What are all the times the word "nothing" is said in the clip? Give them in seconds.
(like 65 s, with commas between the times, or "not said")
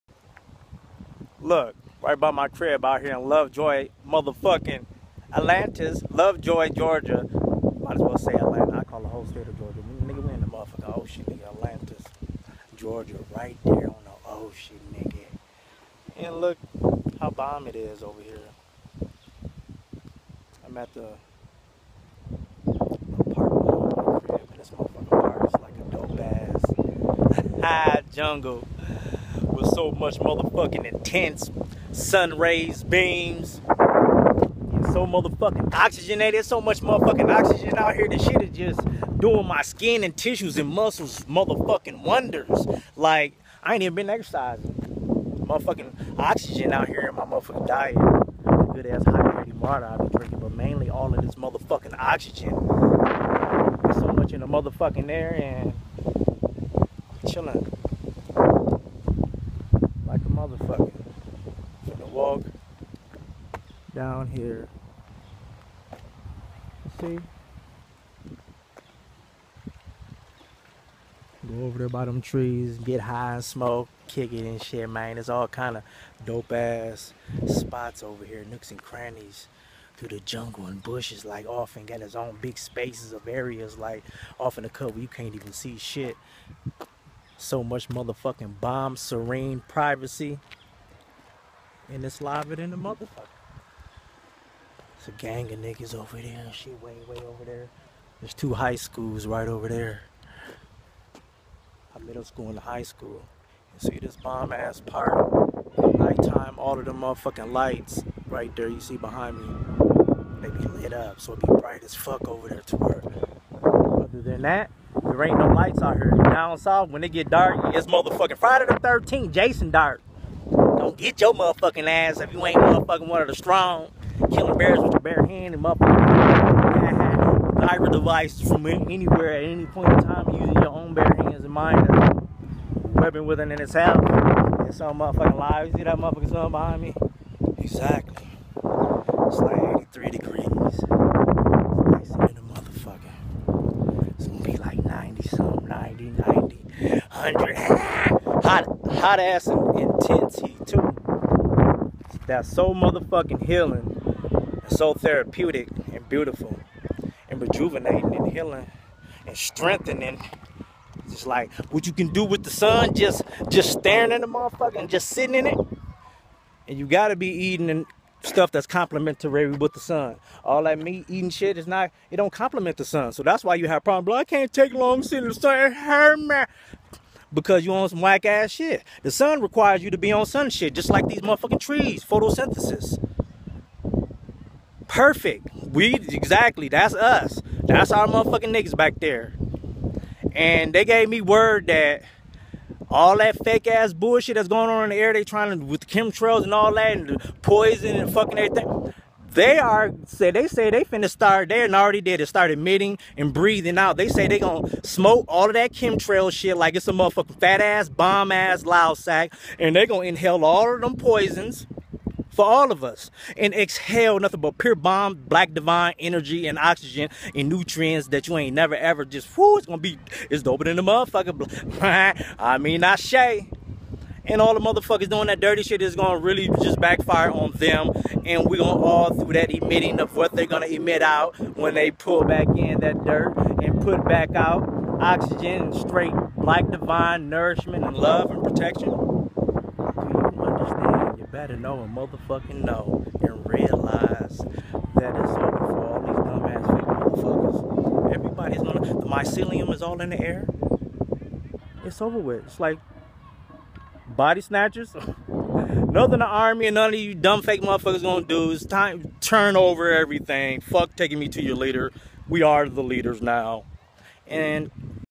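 214 s, 255 s.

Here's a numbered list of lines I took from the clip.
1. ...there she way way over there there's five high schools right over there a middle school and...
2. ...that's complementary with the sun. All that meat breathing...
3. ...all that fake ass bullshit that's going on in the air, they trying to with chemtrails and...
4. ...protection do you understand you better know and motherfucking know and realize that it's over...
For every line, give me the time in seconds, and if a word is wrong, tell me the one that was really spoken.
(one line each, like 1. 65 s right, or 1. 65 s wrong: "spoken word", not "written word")
1. 96 s wrong: "two", not "five"
2. 168 s wrong: "eating", not "breathing"
3. 192 s right
4. 238 s right.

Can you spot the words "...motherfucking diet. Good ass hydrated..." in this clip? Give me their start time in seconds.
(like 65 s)
47 s.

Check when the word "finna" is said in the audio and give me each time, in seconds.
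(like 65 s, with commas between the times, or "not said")
200 s.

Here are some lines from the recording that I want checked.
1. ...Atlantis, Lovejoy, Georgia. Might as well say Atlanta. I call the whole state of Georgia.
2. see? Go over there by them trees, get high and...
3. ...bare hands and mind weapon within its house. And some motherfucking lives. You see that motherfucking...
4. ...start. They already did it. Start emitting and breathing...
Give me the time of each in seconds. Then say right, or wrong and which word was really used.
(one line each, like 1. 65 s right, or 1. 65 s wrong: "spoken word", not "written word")
1. 5 s right
2. 66 s right
3. 130 s right
4. 201 s right.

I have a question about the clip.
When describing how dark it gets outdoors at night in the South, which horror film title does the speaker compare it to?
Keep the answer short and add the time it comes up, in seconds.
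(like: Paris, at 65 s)
Friday the 13th, at 118 s.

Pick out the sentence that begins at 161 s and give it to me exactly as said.
Just like what you can do with the sun, just just staring at the motherfucker and just sitting in it.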